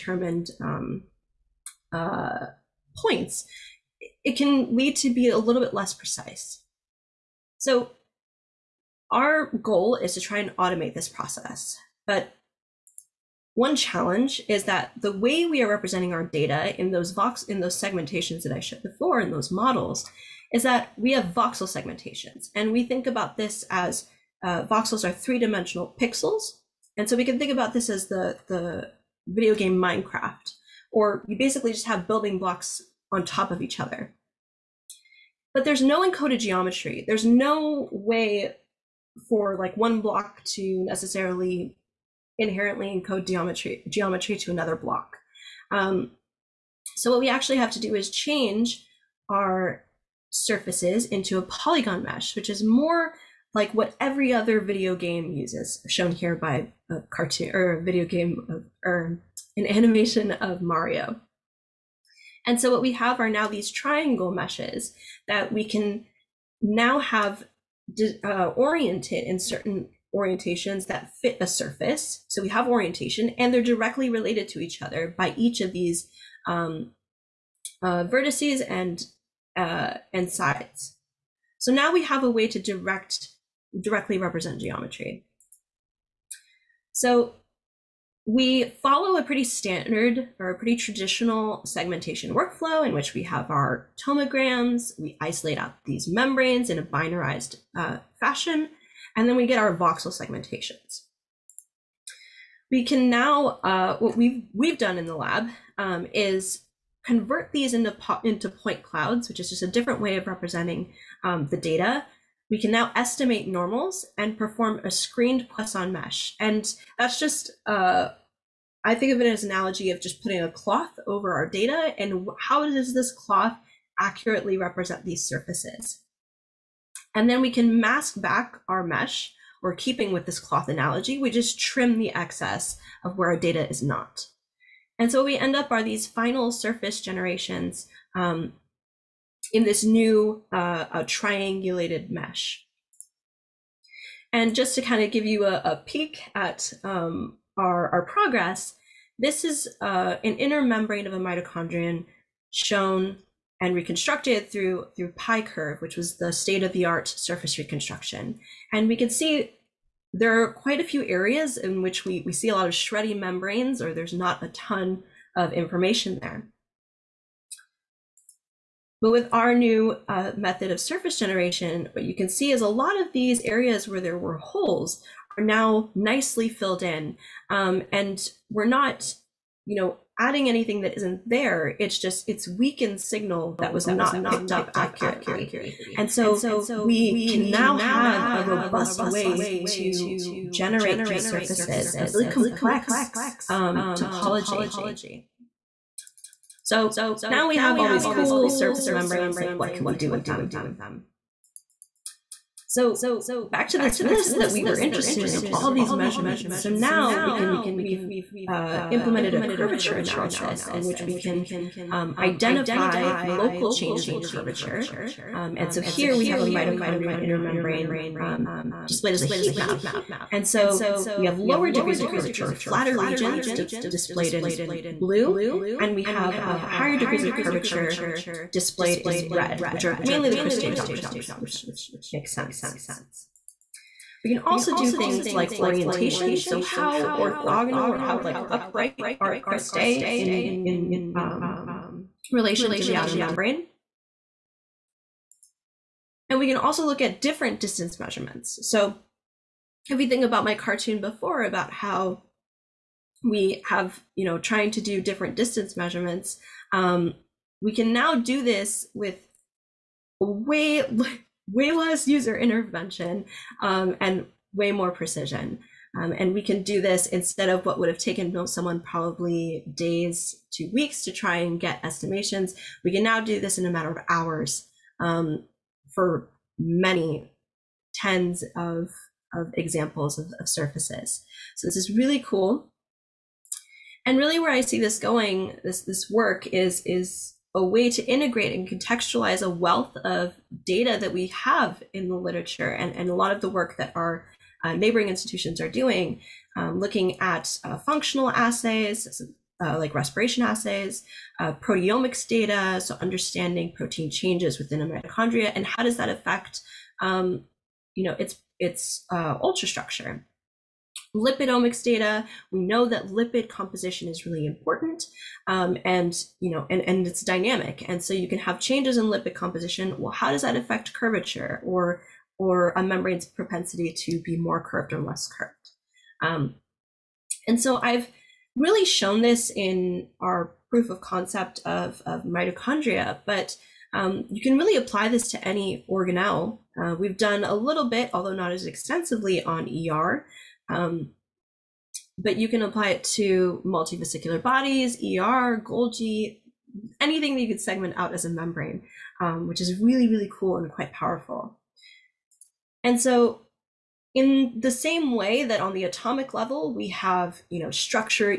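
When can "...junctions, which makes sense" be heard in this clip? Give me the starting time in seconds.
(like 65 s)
230 s.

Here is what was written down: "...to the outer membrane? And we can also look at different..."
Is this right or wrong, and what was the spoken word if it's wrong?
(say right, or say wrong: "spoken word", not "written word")
right.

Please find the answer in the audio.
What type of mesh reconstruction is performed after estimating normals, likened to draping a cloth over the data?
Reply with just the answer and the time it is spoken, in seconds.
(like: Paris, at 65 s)
screened Poisson mesh, at 114 s.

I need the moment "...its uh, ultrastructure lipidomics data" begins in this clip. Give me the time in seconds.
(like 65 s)
308 s.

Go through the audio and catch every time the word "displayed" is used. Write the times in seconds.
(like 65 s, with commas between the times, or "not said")
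218 s, 223 s, 228 s.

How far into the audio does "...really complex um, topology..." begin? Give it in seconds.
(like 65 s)
192 s.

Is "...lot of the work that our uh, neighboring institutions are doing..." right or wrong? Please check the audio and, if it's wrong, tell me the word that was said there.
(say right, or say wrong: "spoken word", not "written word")
right.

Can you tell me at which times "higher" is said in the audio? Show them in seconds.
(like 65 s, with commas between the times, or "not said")
226 s.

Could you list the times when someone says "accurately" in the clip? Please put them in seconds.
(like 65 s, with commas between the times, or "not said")
123 s, 184 s.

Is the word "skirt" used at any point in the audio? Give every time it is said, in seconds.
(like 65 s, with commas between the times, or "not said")
not said.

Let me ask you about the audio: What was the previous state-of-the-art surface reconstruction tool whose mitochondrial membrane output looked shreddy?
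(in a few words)
PyCurv.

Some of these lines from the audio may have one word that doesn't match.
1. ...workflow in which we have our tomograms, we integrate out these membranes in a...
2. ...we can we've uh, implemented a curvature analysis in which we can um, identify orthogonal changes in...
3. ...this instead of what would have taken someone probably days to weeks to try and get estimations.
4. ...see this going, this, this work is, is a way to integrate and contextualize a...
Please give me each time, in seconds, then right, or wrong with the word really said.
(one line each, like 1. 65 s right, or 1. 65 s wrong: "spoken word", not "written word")
1. 92 s wrong: "isolate", not "integrate"
2. 207 s wrong: "local", not "orthogonal"
3. 266 s right
4. 284 s right.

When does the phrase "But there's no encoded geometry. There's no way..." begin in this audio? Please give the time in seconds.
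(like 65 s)
35 s.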